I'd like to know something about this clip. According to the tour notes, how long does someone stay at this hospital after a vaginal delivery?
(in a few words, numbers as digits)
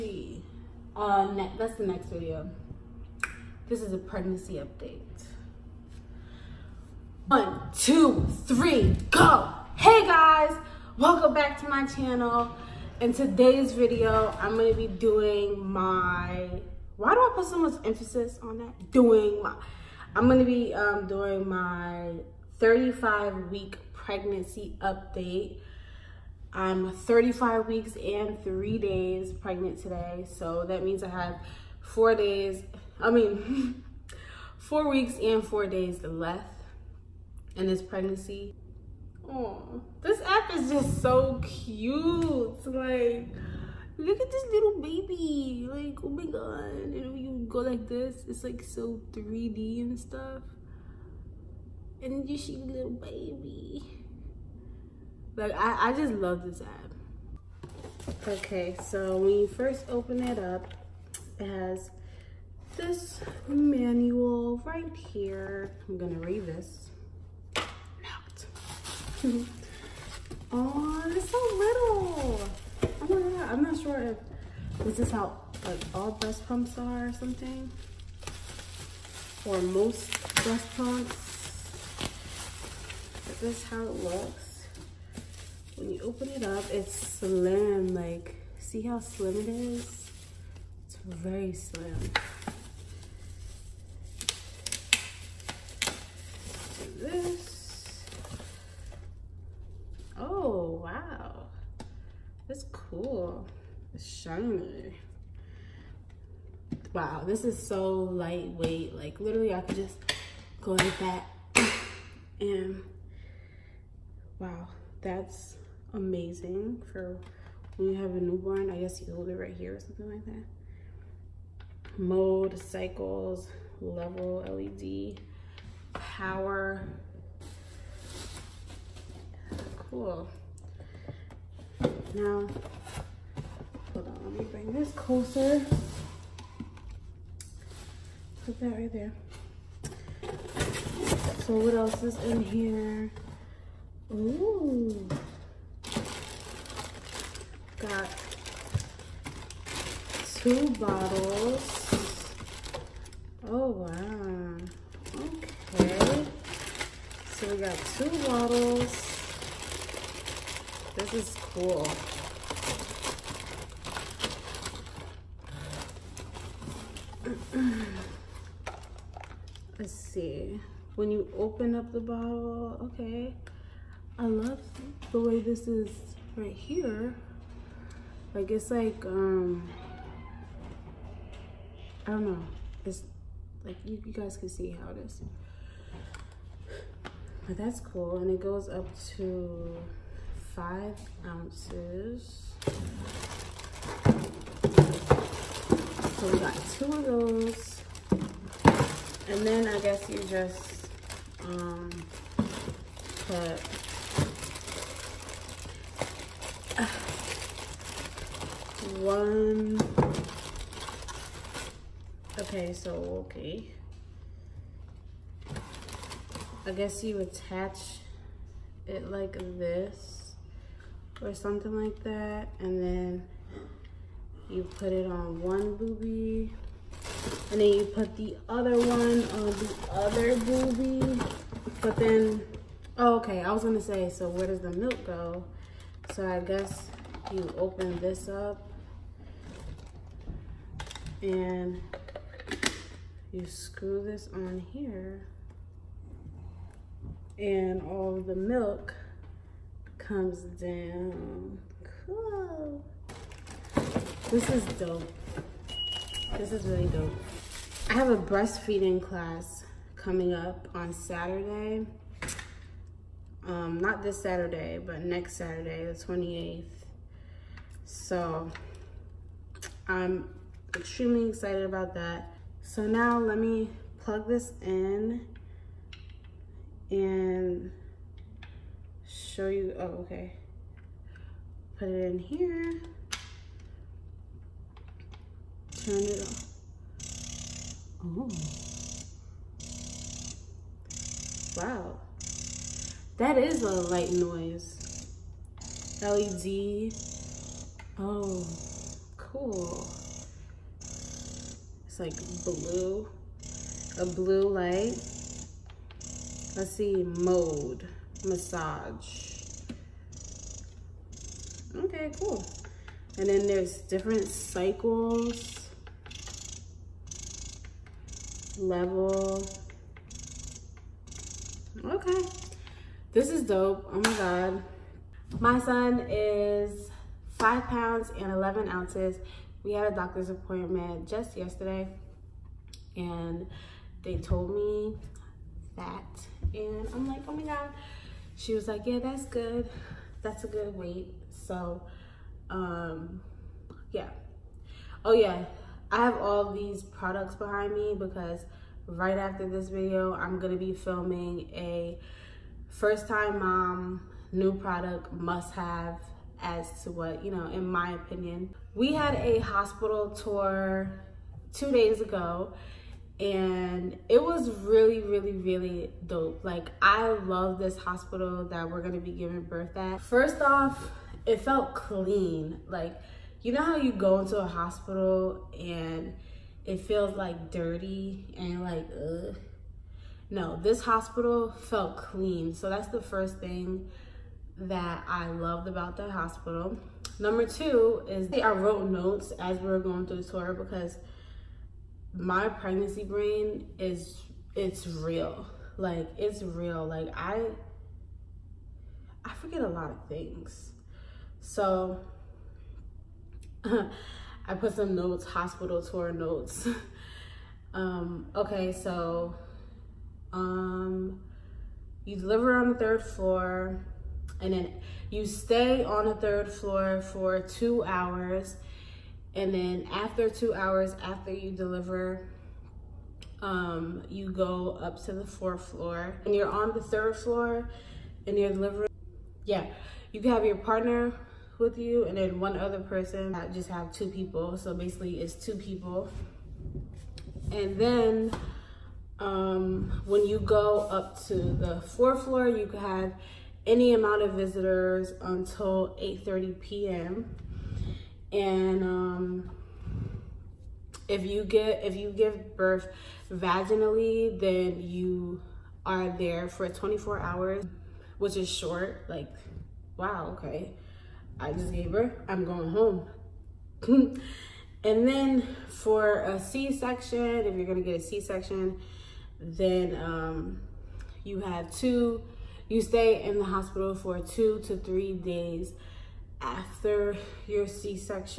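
24 hours.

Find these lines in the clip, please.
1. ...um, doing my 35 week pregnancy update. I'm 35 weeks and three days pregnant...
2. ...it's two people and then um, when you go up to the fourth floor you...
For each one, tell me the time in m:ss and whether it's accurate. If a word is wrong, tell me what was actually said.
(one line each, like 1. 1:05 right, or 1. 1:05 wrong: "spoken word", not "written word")
1. 0:20 right
2. 7:15 right.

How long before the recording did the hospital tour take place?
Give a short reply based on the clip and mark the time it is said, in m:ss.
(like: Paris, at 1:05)
2 days ago, at 6:01.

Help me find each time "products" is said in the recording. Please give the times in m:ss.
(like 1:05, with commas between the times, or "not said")
5:46, 5:54.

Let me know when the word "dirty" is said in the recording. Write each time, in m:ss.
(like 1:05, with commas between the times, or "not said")
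6:17.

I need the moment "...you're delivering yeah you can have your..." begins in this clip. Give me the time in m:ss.
7:08.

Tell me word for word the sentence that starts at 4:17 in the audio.
I have a breastfeeding class coming up on Saturday.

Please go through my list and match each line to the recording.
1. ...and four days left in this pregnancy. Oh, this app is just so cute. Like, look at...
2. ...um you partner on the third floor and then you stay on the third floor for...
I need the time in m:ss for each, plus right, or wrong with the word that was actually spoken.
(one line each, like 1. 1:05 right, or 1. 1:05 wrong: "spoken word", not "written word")
1. 0:35 right
2. 6:50 wrong: "deliver", not "partner".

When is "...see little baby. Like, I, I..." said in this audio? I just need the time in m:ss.
0:52.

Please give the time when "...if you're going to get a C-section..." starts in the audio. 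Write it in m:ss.
7:47.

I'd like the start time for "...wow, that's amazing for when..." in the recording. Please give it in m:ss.
1:54.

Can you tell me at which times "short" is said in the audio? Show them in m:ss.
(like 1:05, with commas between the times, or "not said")
7:38.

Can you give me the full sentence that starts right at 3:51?
But then, oh, okay, I was gonna say, so where does the milk go?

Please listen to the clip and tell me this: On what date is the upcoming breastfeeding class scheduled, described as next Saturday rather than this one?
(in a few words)
the 28th.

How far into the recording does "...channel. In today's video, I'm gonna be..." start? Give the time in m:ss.
0:11.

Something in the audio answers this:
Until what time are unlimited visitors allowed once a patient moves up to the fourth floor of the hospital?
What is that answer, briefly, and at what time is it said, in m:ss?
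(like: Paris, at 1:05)
8:30 p.m., at 7:26.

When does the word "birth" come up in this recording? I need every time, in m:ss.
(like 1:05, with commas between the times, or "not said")
6:09, 7:32, 7:41.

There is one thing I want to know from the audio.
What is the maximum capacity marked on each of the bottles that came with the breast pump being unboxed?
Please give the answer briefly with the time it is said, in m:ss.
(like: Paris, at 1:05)
5 ounces, at 3:10.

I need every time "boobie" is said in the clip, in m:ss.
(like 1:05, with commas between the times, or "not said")
3:45, 3:50.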